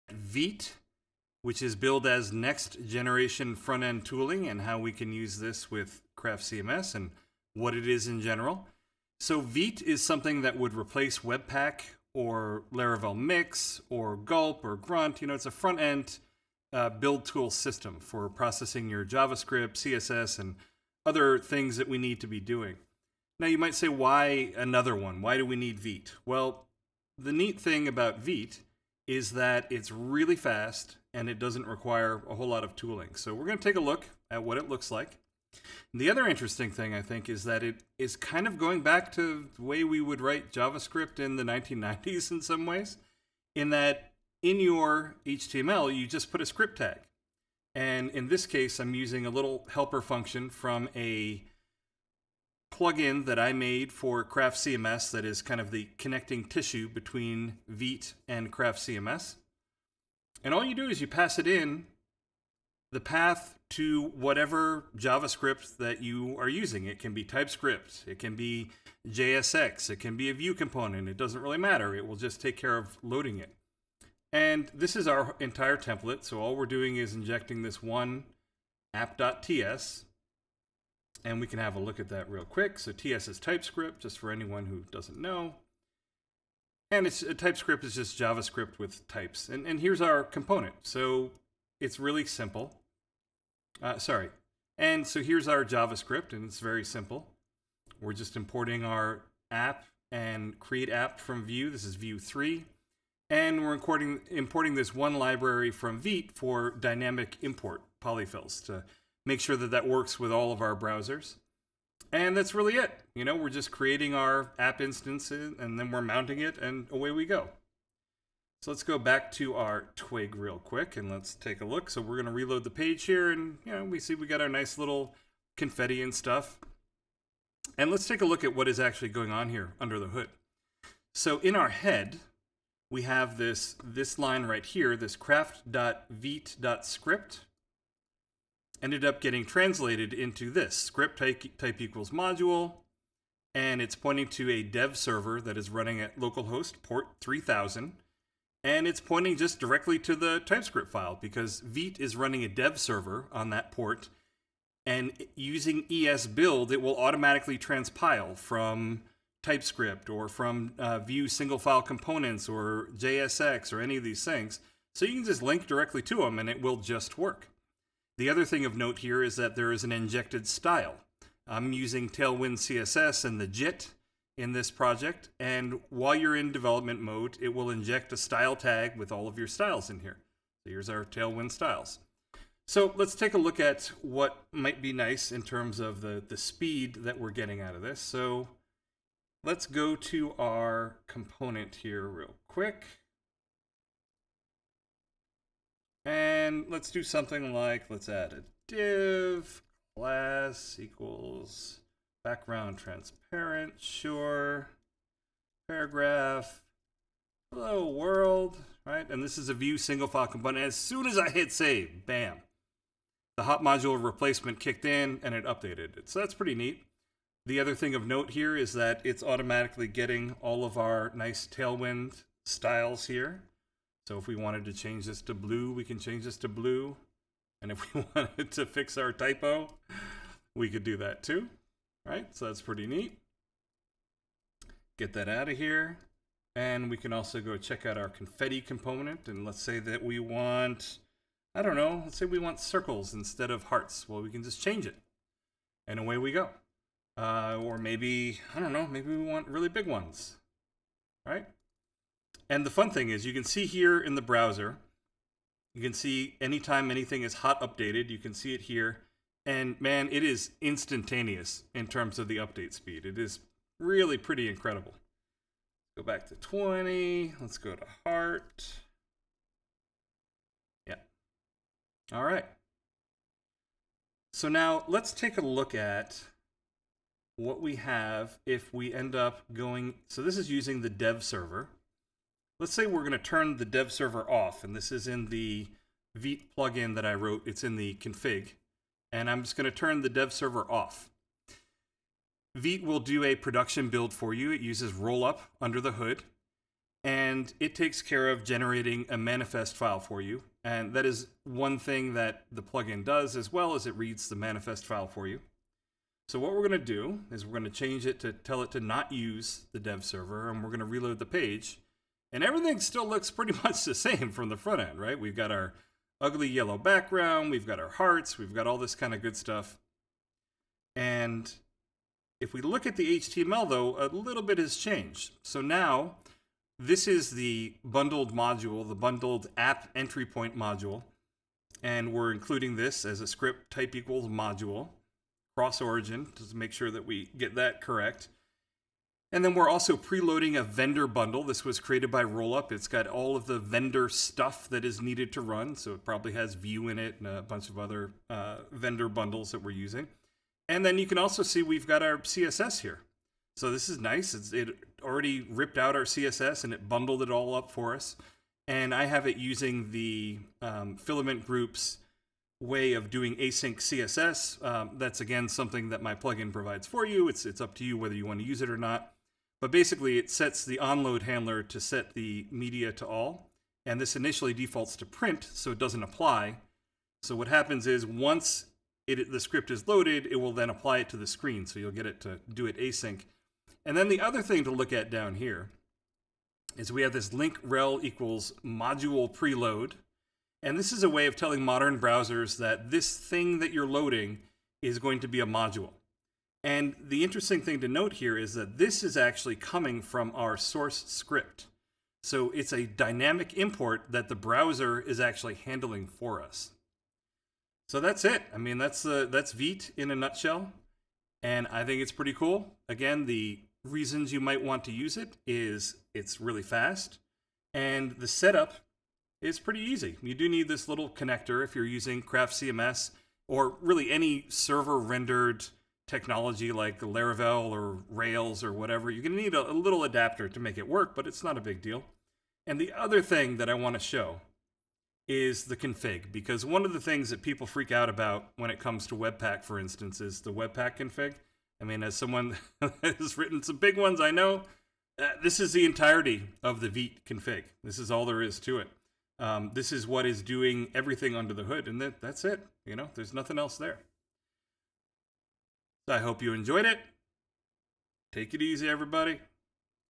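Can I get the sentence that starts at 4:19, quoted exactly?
And man, it is instantaneous in terms of the update speed.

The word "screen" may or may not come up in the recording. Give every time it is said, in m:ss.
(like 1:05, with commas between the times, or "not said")
6:21.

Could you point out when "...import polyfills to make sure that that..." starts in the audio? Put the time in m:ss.
1:47.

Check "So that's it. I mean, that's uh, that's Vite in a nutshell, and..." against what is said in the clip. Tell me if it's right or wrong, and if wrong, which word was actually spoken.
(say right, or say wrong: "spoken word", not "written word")
right.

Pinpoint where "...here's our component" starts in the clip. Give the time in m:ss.
1:29.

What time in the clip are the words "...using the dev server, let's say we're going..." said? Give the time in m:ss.
4:40.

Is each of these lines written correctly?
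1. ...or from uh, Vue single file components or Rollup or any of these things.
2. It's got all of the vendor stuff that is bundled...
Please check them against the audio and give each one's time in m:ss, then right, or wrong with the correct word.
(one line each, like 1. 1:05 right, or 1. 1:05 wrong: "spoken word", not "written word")
1. 2:40 wrong: "JSX", not "Rollup"
2. 5:42 wrong: "needed", not "bundled".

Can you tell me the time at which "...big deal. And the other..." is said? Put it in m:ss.
7:11.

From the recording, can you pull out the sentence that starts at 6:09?
But basically, it sets the onload handler to set the media to all.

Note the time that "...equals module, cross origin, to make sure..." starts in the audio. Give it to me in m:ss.
5:33.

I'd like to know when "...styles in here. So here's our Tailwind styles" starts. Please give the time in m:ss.
2:59.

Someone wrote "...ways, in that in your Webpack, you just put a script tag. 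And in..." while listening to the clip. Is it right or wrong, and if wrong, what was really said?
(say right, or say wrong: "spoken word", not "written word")
wrong: "HTML", not "Webpack".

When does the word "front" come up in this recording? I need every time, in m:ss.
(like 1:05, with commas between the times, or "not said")
0:03, 0:15, 5:14.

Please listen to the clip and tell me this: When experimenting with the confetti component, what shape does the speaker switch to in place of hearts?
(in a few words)
Circles.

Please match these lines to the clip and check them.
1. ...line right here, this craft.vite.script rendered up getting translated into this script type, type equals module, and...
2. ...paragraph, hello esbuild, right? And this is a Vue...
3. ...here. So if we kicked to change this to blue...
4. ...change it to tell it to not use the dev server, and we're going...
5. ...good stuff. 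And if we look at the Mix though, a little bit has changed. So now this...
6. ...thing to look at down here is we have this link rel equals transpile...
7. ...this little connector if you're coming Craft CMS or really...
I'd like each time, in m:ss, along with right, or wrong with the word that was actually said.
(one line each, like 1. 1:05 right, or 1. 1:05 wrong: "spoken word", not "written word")
1. 2:14 wrong: "ended", not "rendered"
2. 3:25 wrong: "world", not "esbuild"
3. 3:43 wrong: "wanted", not "kicked"
4. 5:07 right
5. 5:19 wrong: "HTML", not "Mix"
6. 6:24 wrong: "module", not "transpile"
7. 7:00 wrong: "using", not "coming".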